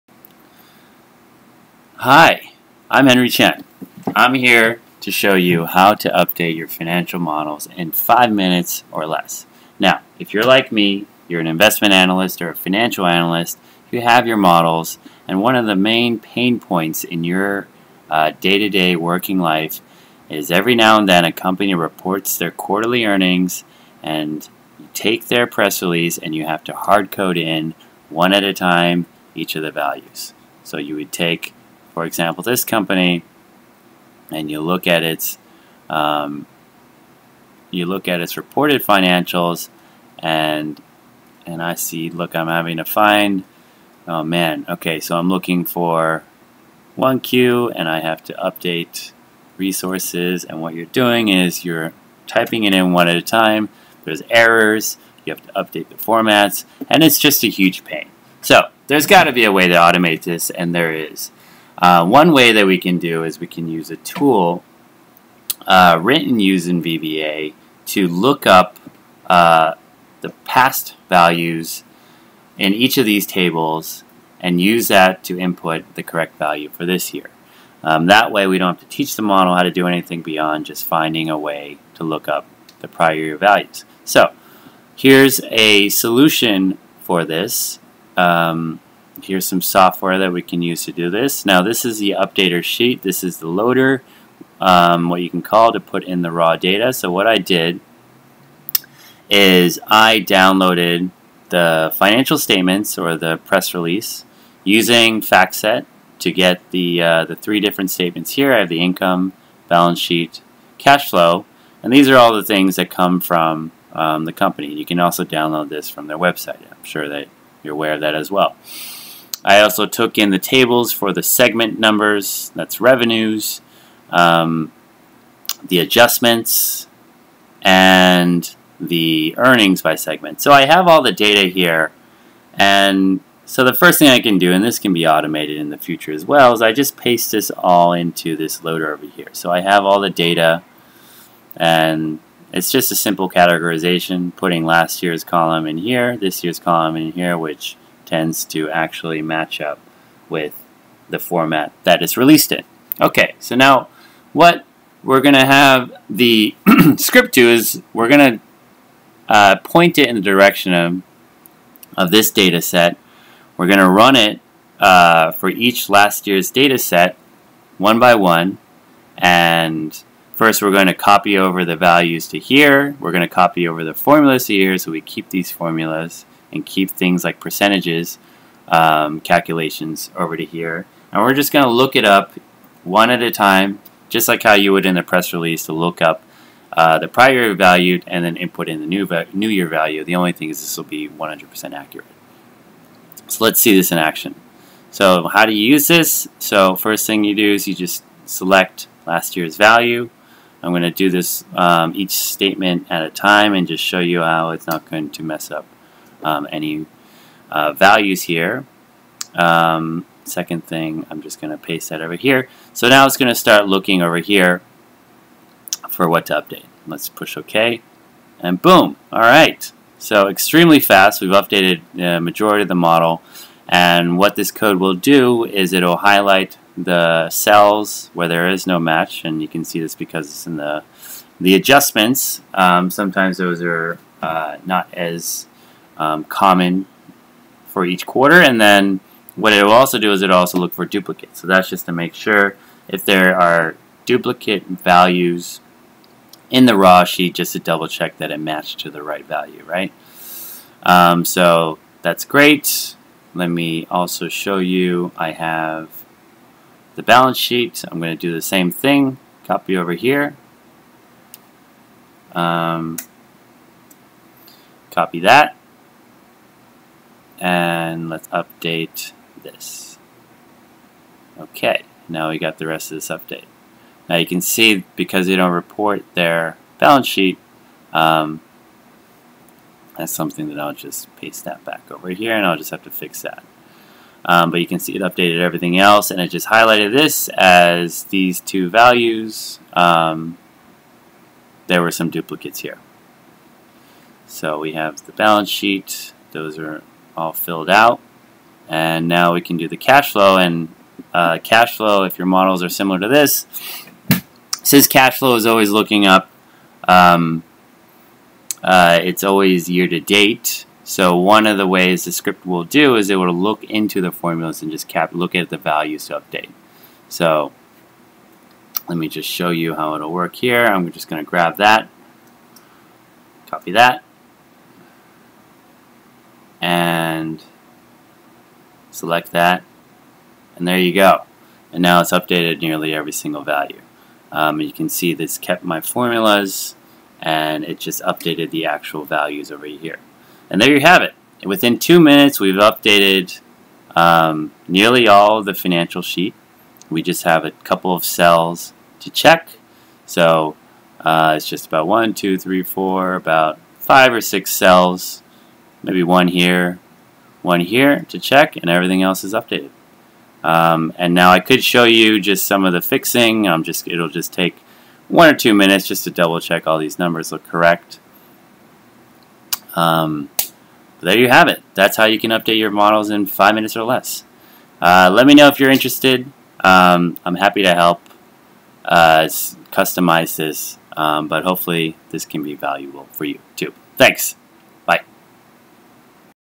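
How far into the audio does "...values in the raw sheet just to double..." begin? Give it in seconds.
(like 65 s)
244 s.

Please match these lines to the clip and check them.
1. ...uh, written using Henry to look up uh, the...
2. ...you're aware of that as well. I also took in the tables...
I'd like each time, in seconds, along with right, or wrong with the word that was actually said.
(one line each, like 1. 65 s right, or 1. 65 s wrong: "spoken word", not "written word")
1. 65 s wrong: "VBA", not "Henry"
2. 117 s right.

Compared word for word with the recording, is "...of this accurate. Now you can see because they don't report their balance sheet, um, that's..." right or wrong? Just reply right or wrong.
wrong.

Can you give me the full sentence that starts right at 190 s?
The only thing is this will be 100% accurate.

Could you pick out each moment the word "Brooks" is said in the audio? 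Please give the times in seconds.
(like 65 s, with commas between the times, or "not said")
not said.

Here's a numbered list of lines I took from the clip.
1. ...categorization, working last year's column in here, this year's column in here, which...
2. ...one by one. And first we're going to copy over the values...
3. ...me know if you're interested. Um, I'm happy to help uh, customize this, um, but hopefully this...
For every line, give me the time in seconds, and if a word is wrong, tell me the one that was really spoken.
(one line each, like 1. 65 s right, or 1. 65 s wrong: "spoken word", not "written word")
1. 143 s wrong: "putting", not "working"
2. 167 s right
3. 375 s right.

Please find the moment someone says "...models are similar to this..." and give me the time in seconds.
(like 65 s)
302 s.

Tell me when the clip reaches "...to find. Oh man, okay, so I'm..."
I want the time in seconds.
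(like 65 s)
42 s.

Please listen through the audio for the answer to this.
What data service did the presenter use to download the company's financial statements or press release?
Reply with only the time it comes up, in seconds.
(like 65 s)
105 s.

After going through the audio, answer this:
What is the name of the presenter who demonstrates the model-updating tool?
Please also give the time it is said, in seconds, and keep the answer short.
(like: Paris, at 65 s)
Henry Chien, at 3 s.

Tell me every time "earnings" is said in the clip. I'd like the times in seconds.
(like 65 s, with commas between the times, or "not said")
23 s, 129 s.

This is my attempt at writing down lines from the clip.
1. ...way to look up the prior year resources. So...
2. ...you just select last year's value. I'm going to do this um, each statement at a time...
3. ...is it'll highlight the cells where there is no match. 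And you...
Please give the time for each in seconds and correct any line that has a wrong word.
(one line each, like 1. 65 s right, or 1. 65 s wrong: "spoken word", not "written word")
1. 81 s wrong: "values", not "resources"
2. 197 s right
3. 225 s right.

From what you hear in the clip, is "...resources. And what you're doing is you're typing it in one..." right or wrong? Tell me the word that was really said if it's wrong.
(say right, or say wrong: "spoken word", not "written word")
right.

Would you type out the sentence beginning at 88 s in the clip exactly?
Um, here's some software that we can use to do this.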